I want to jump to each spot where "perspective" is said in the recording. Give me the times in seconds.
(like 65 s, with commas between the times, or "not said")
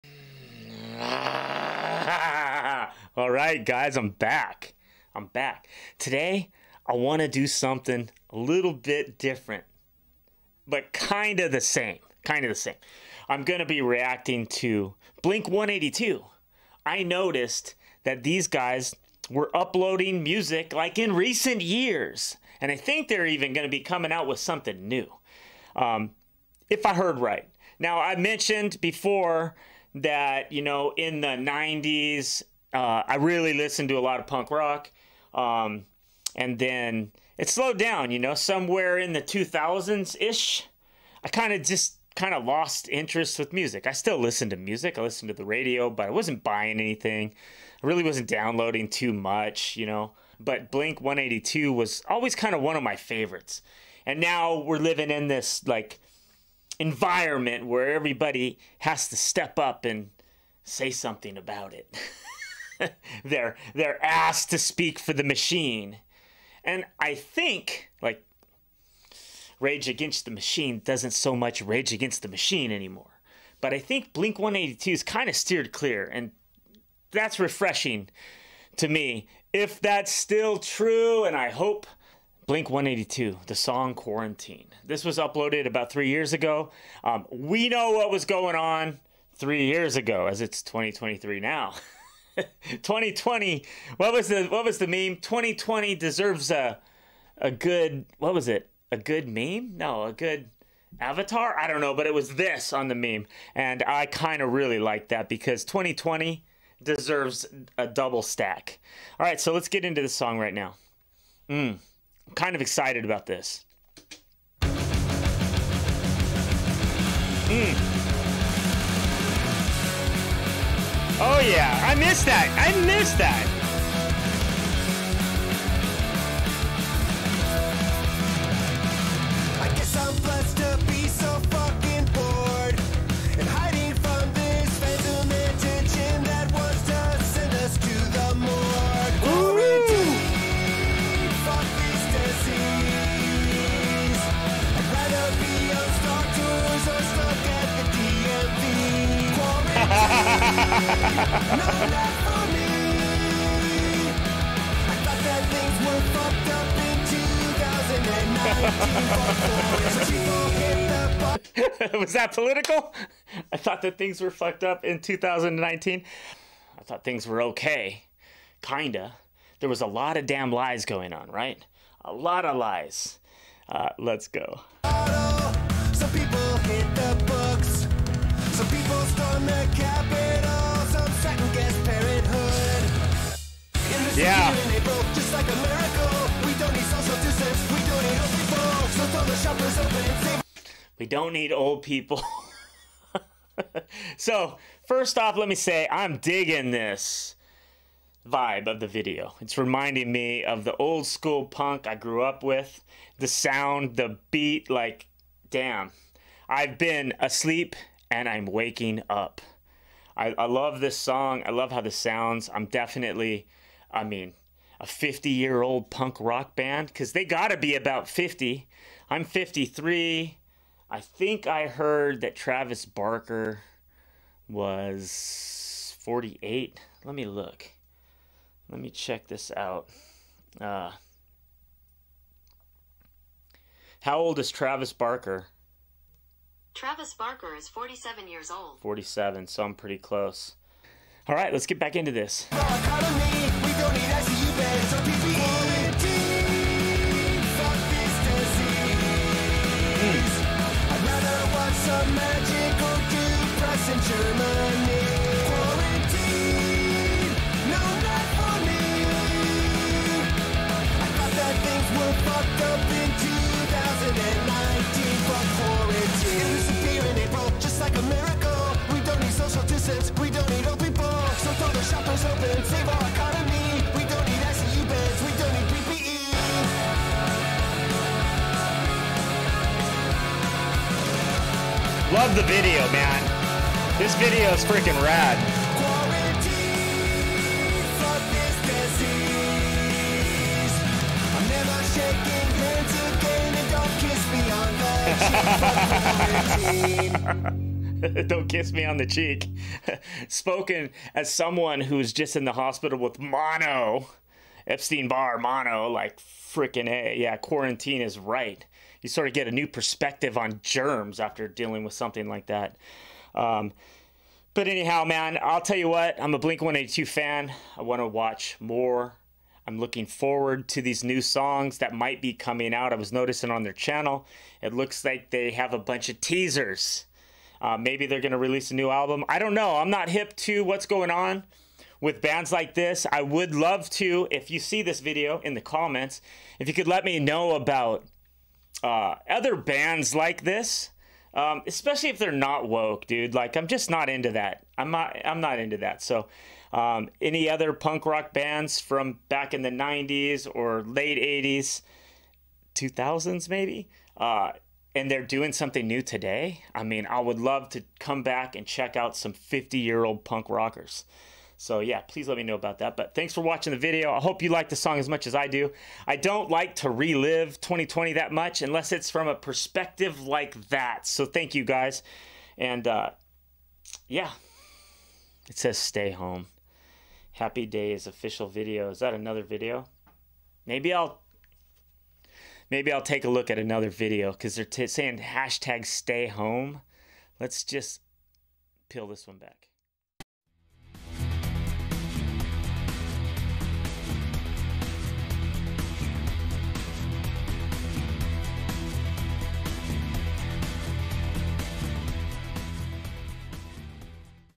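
309 s, 369 s.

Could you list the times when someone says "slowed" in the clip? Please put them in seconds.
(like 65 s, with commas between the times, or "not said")
37 s.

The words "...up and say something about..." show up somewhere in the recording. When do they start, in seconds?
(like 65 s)
59 s.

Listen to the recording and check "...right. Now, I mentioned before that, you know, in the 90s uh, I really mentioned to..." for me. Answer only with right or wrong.
wrong.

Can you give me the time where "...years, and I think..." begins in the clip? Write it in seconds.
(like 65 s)
21 s.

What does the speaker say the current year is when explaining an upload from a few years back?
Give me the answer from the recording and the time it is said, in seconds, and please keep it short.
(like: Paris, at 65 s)
2023, at 90 s.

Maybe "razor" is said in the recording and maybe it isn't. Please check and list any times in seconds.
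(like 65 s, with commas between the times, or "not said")
not said.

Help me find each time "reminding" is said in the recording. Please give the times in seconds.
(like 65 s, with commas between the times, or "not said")
199 s.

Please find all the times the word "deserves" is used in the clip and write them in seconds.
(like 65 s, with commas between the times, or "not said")
95 s, 106 s.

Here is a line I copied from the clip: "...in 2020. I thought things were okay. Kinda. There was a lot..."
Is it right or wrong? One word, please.
wrong.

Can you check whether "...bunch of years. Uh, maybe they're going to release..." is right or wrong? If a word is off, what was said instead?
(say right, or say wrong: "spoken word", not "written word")
wrong: "teasers", not "years".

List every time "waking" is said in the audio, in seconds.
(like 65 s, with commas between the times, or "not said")
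208 s.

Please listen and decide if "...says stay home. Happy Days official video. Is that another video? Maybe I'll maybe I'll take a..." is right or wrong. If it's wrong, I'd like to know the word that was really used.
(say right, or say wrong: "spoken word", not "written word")
right.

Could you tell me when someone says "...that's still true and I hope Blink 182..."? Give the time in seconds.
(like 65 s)
79 s.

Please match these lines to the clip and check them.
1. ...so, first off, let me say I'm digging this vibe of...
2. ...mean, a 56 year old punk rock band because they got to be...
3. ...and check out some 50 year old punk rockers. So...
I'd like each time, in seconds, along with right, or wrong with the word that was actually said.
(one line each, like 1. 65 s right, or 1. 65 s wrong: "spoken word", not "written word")
1. 194 s right
2. 214 s wrong: "50", not "56"
3. 358 s right.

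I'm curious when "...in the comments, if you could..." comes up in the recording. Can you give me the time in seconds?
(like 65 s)
335 s.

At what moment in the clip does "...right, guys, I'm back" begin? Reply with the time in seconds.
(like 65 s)
3 s.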